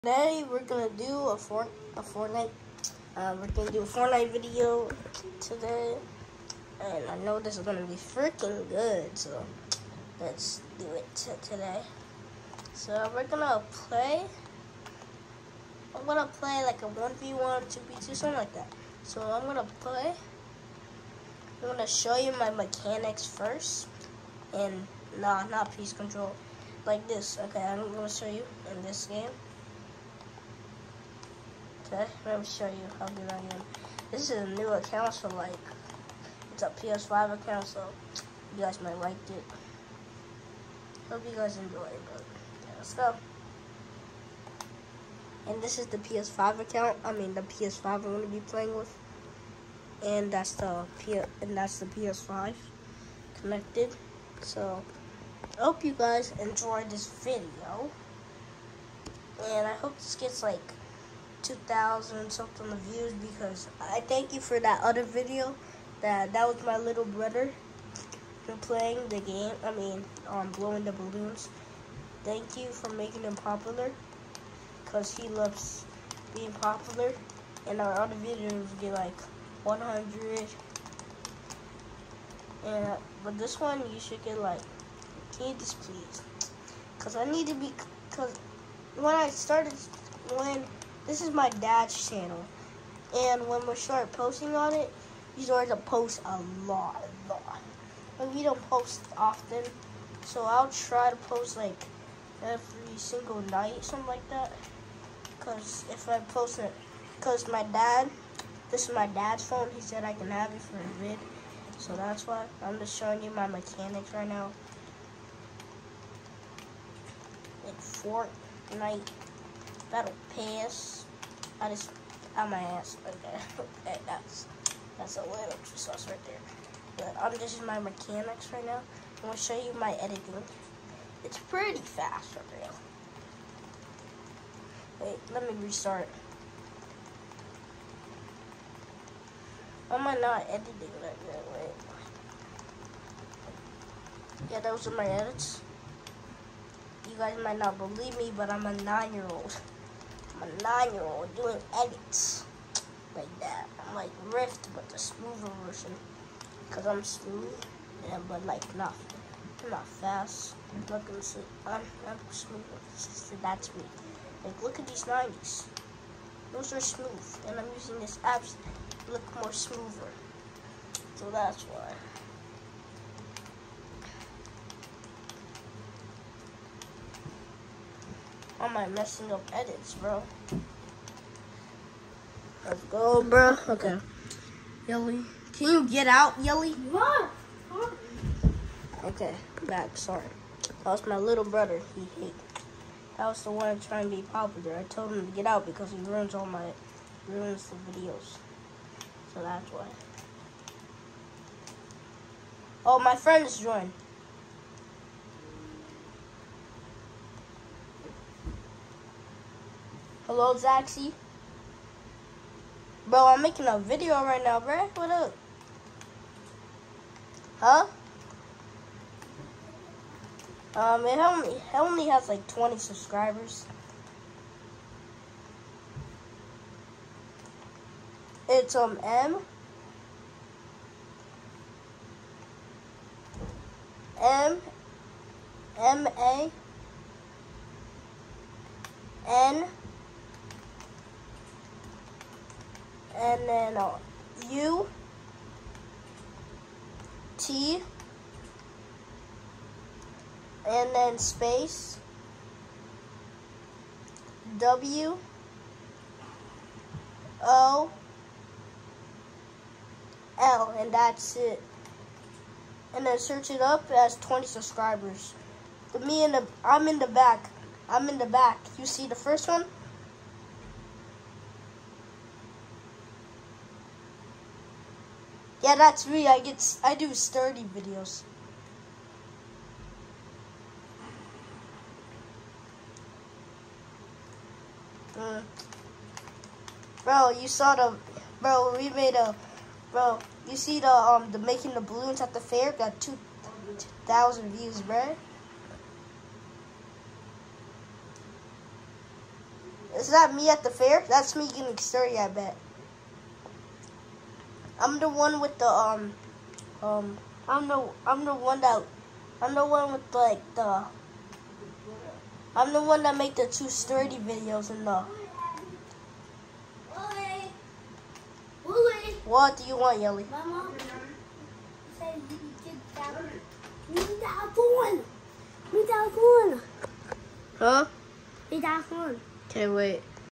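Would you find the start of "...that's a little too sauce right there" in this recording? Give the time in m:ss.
2:04.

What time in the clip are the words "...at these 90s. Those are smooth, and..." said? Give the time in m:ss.
2:44.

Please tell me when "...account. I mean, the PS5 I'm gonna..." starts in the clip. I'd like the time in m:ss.
0:46.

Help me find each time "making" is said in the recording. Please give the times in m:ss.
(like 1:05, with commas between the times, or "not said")
1:12, 3:33, 4:51.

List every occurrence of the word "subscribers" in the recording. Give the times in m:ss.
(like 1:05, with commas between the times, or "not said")
3:42, 4:24.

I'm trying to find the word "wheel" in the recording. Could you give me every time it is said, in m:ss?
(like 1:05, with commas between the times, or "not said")
not said.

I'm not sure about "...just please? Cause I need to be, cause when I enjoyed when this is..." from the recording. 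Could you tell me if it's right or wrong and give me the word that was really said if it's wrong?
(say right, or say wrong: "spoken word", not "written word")
wrong: "started", not "enjoyed".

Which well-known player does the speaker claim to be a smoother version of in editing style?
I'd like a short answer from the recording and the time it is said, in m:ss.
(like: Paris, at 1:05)
Rift, at 2:34.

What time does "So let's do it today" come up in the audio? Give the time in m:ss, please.
0:09.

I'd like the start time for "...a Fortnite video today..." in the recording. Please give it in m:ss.
0:03.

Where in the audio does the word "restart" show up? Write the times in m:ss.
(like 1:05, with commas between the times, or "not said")
2:15.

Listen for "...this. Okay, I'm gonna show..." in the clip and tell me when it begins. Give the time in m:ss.
0:27.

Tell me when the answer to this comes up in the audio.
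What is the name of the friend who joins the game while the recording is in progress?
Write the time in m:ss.
3:30.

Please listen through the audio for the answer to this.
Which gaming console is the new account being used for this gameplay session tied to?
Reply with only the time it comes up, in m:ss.
0:36.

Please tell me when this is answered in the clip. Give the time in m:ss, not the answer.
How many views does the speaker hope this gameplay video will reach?
1:01.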